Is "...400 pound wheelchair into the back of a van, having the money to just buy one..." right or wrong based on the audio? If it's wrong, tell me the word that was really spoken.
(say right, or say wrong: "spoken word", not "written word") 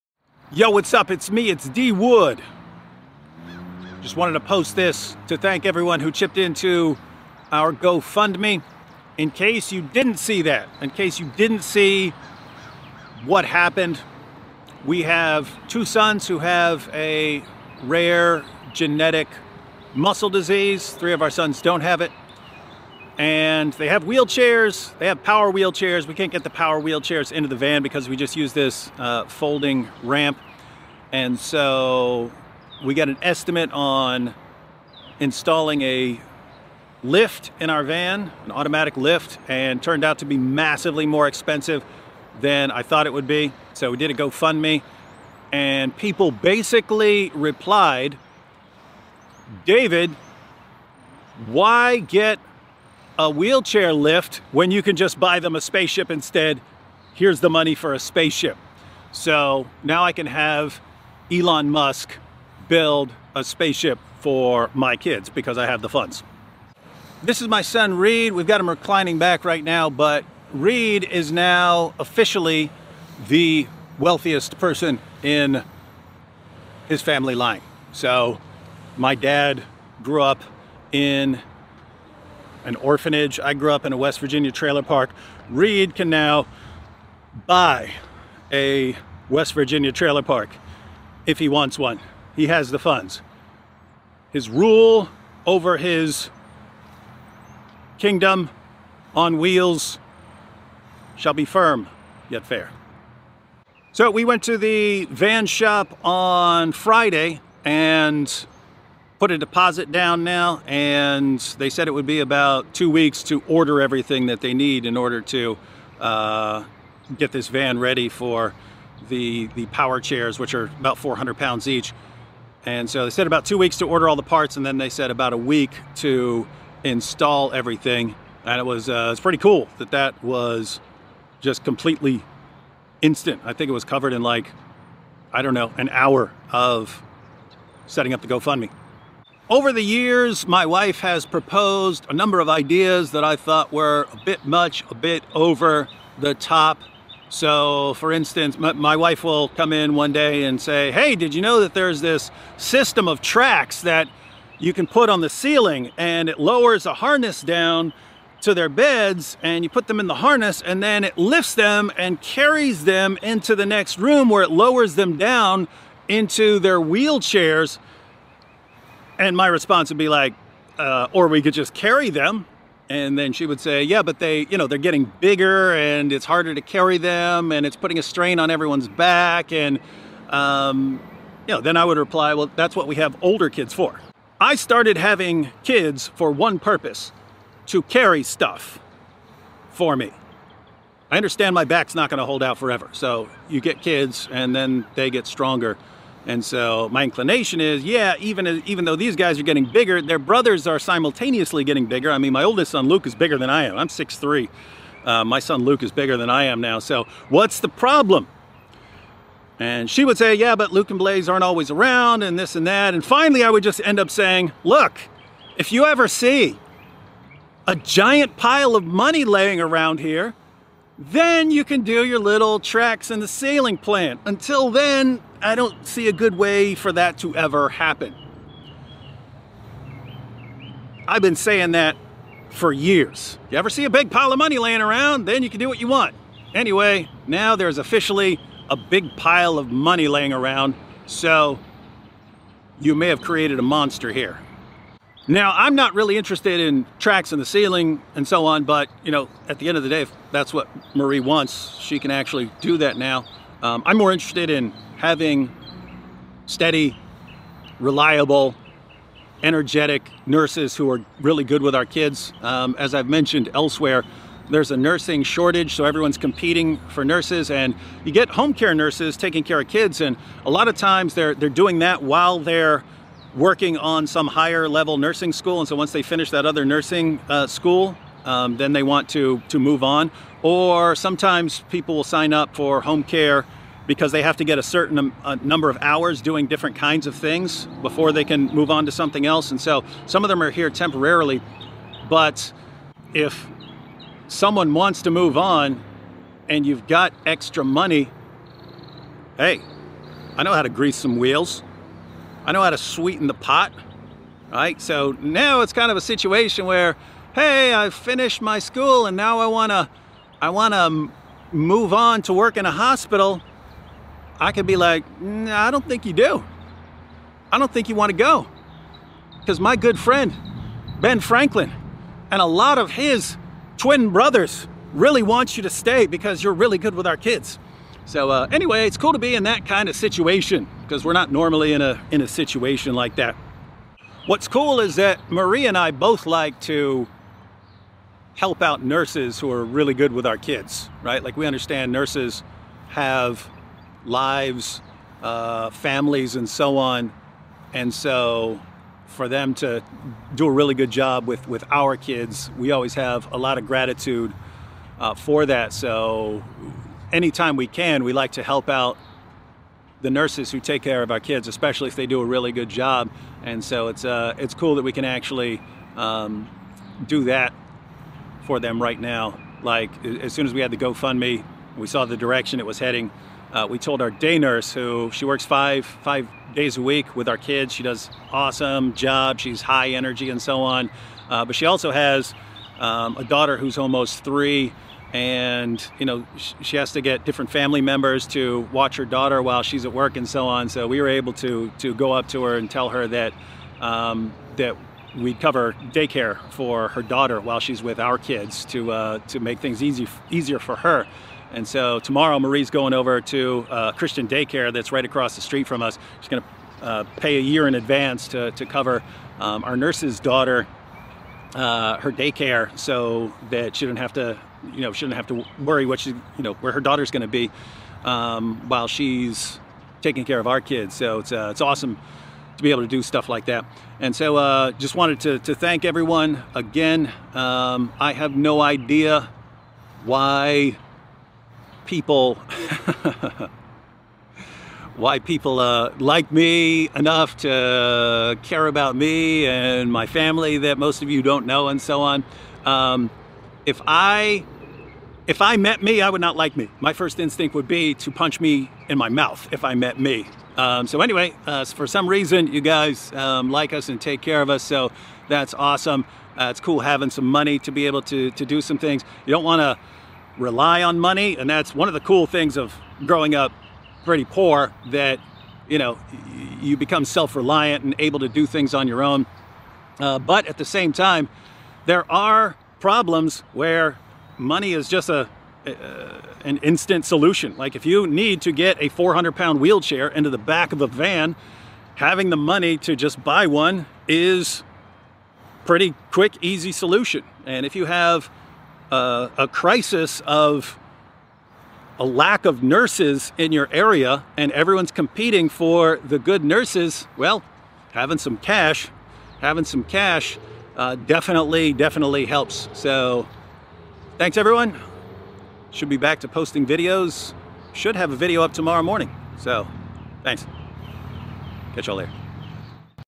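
right.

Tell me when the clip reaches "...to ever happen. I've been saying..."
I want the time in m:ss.
3:47.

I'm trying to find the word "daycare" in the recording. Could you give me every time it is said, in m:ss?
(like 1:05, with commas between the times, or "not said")
6:35, 6:44, 6:52.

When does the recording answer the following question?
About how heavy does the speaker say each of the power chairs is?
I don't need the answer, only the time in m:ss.
2:00.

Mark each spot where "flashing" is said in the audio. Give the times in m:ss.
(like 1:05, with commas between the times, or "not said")
not said.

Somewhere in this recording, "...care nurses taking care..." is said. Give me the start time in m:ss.
4:28.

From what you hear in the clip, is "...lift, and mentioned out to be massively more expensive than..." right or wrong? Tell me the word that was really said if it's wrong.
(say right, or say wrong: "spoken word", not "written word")
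wrong: "turned", not "mentioned".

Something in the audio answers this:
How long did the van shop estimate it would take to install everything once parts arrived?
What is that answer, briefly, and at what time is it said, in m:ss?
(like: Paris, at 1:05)
about a week, at 2:05.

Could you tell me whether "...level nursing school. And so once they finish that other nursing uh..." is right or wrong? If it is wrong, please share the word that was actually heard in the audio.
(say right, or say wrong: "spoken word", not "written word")
right.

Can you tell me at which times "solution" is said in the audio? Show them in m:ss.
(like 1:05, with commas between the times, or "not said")
7:57, 8:06.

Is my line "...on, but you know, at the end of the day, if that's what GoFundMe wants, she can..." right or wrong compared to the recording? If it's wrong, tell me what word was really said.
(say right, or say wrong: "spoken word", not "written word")
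wrong: "Marie", not "GoFundMe".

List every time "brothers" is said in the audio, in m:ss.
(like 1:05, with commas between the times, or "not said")
3:20, 5:24.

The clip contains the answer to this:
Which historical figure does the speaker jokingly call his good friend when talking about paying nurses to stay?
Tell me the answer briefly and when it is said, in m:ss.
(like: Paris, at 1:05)
Ben Franklin, at 5:20.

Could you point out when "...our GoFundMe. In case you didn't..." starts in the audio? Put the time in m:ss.
0:07.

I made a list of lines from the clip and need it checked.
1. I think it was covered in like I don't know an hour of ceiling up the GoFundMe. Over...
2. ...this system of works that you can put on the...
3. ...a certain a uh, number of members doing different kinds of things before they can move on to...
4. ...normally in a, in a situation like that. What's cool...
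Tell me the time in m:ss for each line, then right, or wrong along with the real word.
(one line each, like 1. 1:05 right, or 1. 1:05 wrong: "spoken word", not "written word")
1. 2:13 wrong: "setting", not "ceiling"
2. 2:31 wrong: "tracks", not "works"
3. 4:44 wrong: "hours", not "members"
4. 5:31 right.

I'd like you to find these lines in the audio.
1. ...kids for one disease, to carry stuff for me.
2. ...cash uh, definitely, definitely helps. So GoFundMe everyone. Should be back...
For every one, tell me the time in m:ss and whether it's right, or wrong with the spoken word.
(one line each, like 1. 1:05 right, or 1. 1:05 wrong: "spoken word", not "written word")
1. 3:05 wrong: "purpose", not "disease"
2. 8:19 wrong: "Thanks", not "GoFundMe".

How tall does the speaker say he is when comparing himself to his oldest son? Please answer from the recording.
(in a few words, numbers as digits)
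6'3".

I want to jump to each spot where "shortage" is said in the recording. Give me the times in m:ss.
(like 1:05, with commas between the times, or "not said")
4:25.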